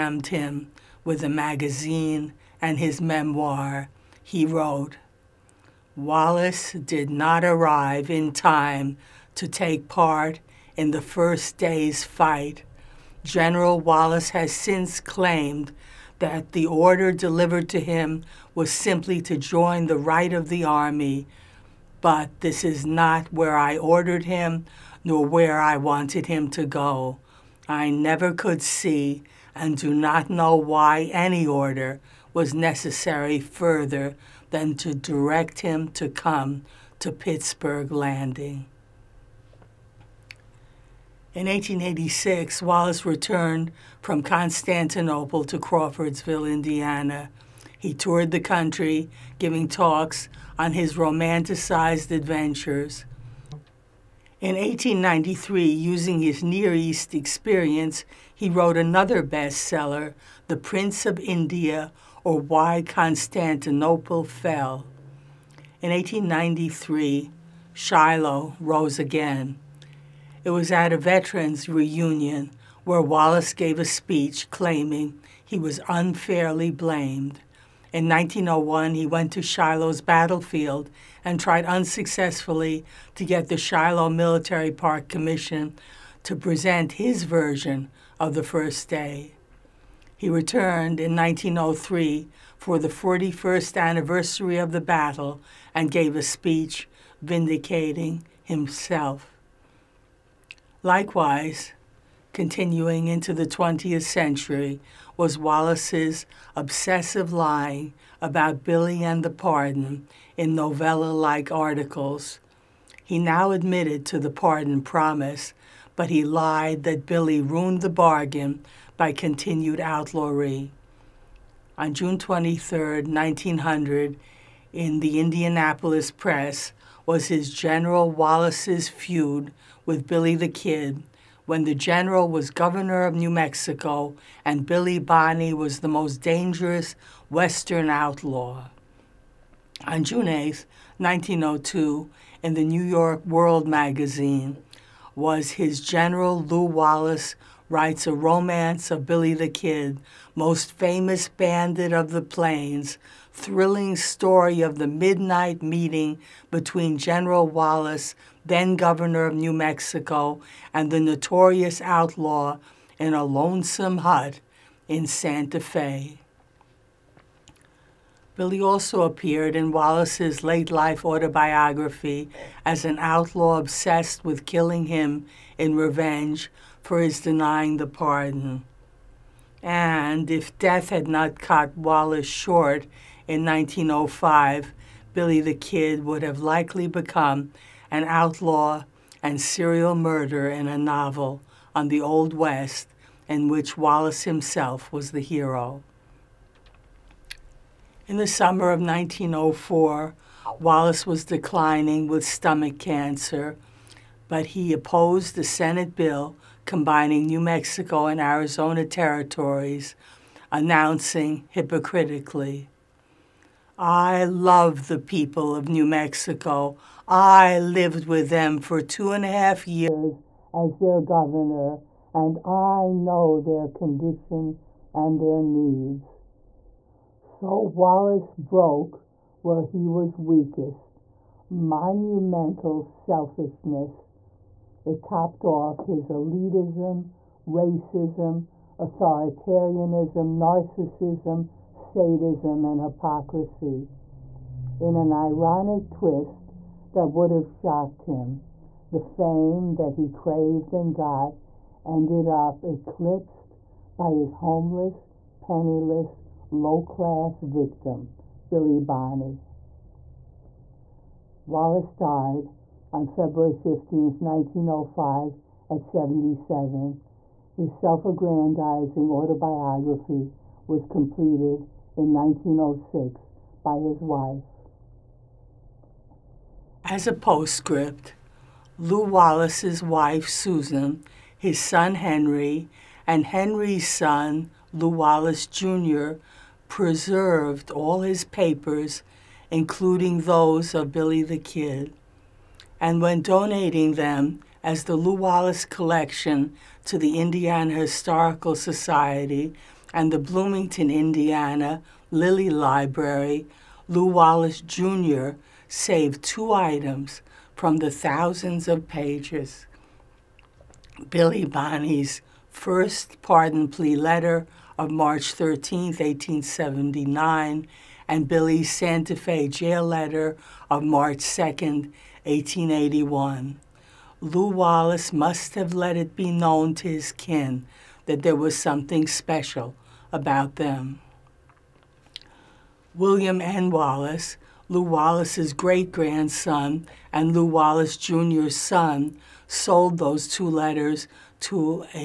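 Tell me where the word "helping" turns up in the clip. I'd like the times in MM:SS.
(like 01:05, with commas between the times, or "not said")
not said.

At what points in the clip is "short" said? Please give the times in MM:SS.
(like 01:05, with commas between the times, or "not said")
03:02.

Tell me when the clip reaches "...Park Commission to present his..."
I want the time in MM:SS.
01:24.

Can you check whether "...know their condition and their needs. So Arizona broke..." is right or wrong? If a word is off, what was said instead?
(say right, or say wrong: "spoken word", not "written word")
wrong: "Wallace", not "Arizona".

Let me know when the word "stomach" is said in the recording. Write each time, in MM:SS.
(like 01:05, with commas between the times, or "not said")
03:22.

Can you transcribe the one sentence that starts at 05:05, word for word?
saved two items from the thousands of pages.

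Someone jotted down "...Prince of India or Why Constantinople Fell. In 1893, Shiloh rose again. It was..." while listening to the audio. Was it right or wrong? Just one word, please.
right.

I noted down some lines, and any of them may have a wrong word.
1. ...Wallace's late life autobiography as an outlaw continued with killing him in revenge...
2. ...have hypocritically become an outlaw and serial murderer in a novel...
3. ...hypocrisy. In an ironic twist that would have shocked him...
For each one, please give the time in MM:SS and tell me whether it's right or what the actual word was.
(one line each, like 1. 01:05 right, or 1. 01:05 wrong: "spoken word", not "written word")
1. 02:49 wrong: "obsessed", not "continued"
2. 03:06 wrong: "likely", not "hypocritically"
3. 04:02 right.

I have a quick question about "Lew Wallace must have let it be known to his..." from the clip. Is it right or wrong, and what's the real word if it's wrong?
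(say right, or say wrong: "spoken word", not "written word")
right.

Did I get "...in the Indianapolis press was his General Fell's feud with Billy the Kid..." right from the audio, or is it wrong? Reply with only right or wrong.
wrong.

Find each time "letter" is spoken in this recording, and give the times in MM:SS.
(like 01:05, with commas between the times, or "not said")
05:13, 05:19, 05:40.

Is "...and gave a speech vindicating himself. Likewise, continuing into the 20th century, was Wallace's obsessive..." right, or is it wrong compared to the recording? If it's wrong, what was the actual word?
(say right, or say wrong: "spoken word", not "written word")
right.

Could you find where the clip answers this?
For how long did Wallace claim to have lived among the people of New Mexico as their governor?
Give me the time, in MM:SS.
03:38.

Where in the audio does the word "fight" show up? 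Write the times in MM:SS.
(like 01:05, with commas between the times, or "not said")
00:12.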